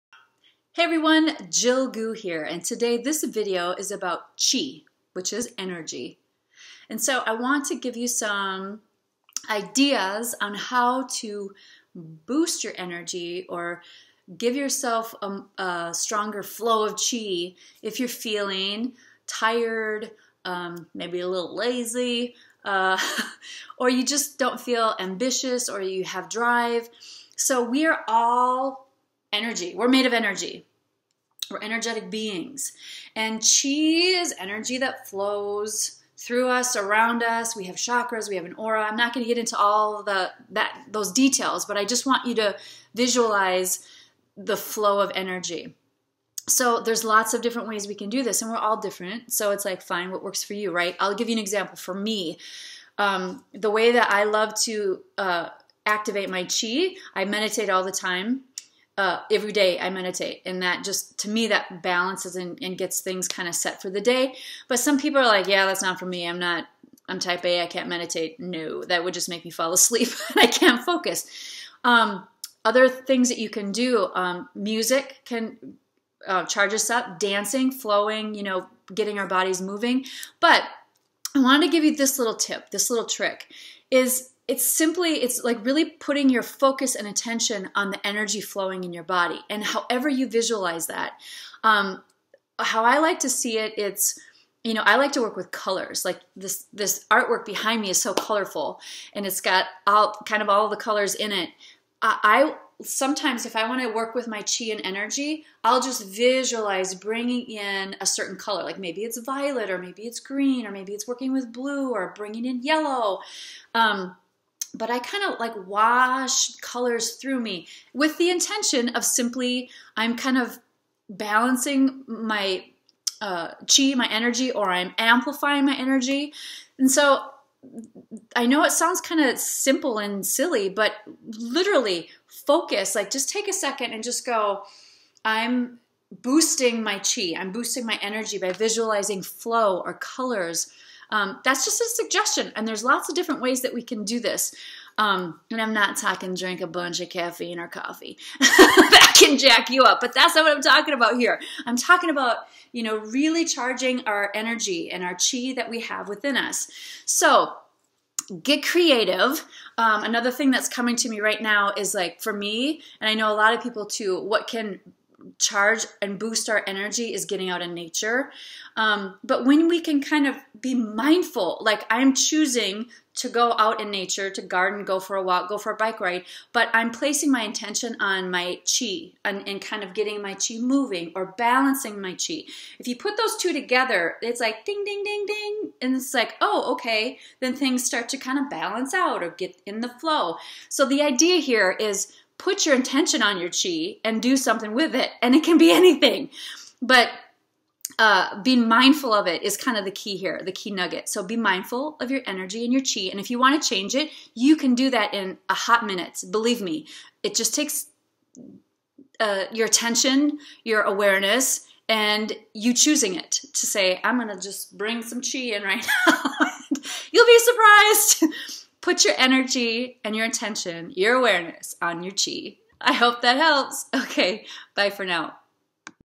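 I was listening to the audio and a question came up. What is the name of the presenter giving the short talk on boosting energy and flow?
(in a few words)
Jill Goux.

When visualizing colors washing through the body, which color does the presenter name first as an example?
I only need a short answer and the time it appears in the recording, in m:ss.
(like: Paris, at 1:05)
violet, at 1:49.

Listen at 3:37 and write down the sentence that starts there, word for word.
You'll be surprised put your energy and your attention, your awareness on your chi.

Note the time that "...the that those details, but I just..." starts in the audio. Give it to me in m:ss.
0:40.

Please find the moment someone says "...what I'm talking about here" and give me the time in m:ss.
2:30.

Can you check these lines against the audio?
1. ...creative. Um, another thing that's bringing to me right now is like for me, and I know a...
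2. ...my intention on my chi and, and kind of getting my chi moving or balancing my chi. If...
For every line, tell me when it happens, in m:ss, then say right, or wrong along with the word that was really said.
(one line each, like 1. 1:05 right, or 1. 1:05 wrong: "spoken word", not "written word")
1. 2:38 wrong: "coming", not "bringing"
2. 2:57 right.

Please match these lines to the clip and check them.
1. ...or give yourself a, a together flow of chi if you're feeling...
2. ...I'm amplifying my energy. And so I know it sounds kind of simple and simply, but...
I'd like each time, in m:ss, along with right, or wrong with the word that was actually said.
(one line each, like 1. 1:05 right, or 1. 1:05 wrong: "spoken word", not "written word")
1. 0:13 wrong: "stronger", not "together"
2. 2:04 wrong: "silly", not "simply".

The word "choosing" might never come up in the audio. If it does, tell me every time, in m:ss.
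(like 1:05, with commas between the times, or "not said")
2:52, 3:32.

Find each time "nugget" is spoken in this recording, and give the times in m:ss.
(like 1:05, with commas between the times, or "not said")
3:20.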